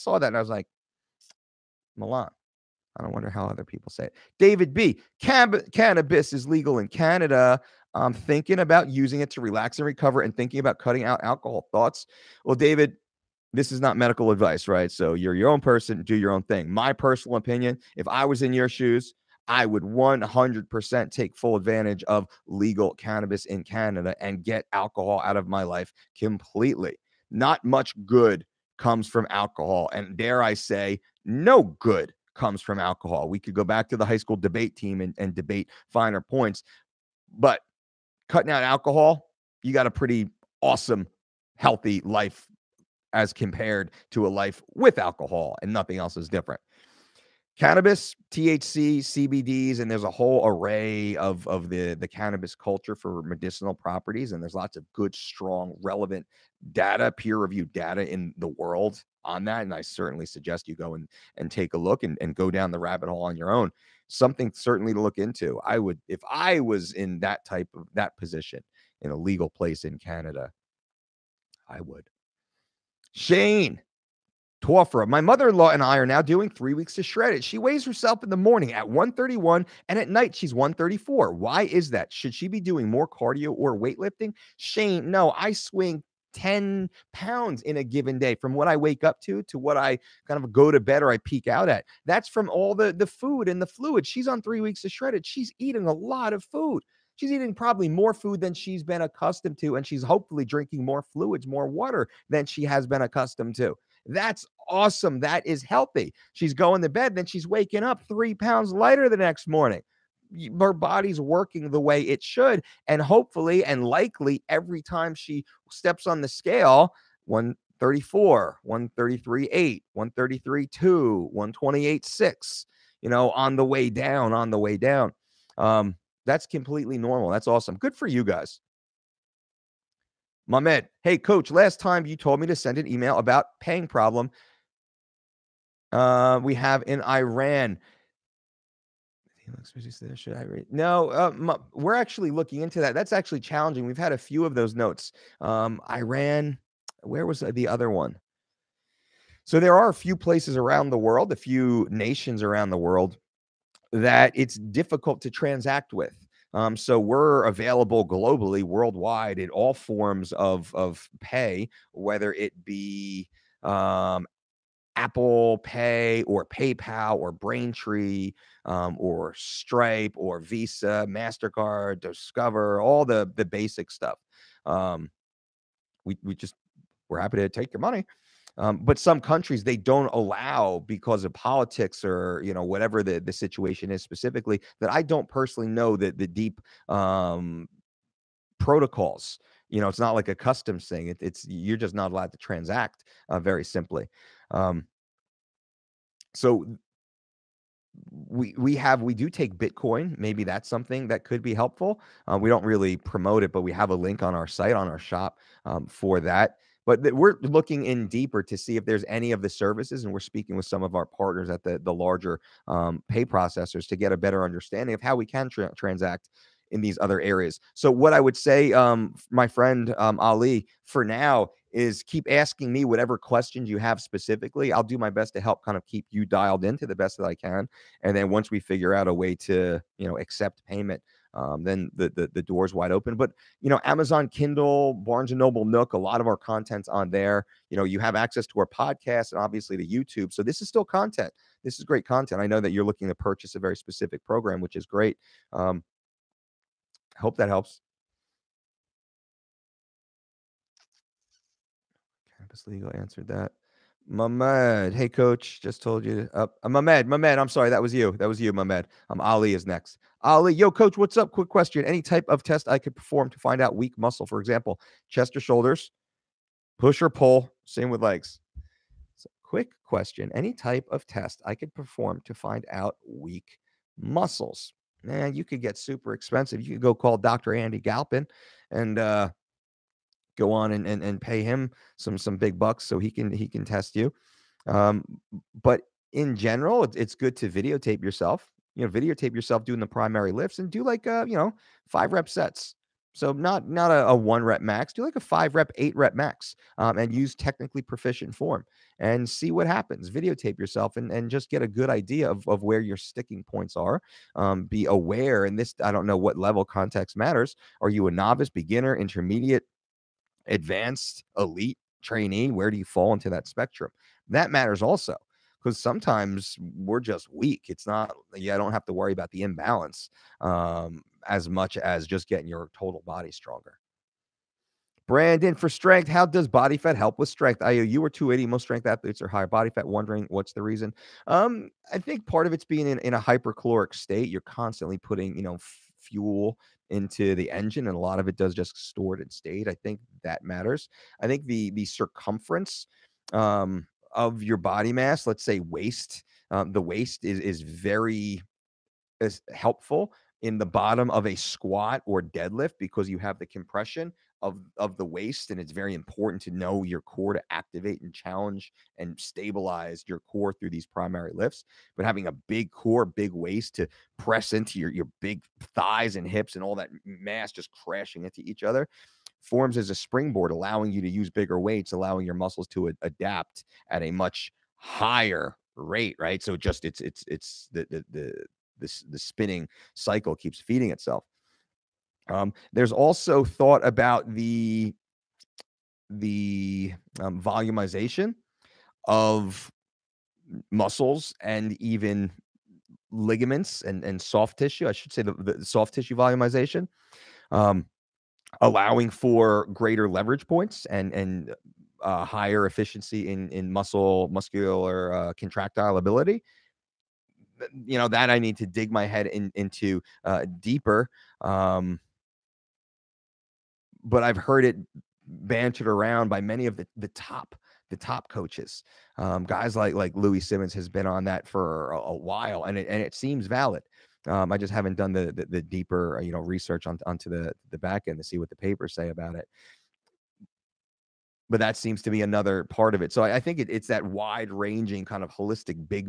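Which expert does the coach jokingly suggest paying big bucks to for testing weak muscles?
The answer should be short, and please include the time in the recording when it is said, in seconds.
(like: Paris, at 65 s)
Andy Galpin, at 277 s.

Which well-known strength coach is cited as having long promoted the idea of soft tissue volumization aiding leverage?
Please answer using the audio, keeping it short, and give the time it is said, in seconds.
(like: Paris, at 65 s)
Louie Simmons, at 420 s.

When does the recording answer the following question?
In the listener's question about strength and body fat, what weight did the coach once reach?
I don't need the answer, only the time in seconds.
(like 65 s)
328 s.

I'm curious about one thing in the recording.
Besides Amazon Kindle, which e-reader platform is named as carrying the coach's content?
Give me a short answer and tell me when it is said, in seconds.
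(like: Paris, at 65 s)
Barnes and Noble Nook, at 234 s.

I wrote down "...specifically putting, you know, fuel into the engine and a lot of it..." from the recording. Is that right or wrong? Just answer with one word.
wrong.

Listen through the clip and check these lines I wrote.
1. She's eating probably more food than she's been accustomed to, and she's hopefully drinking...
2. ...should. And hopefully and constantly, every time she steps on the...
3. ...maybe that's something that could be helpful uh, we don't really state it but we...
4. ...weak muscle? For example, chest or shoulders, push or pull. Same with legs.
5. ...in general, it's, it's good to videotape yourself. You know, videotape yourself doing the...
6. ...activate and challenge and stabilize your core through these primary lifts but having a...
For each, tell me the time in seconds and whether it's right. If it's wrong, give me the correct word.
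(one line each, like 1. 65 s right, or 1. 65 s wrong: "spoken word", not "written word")
1. 97 s right
2. 112 s wrong: "likely", not "constantly"
3. 200 s wrong: "promote", not "state"
4. 263 s right
5. 286 s right
6. 357 s right.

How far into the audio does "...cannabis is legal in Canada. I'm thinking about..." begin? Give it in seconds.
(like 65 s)
5 s.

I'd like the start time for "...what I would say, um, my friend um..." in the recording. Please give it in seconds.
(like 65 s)
217 s.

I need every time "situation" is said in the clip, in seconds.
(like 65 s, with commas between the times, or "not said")
183 s.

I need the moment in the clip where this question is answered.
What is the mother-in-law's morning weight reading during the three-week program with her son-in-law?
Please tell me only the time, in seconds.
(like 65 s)
78 s.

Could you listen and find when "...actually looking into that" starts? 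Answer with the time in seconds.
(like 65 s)
141 s.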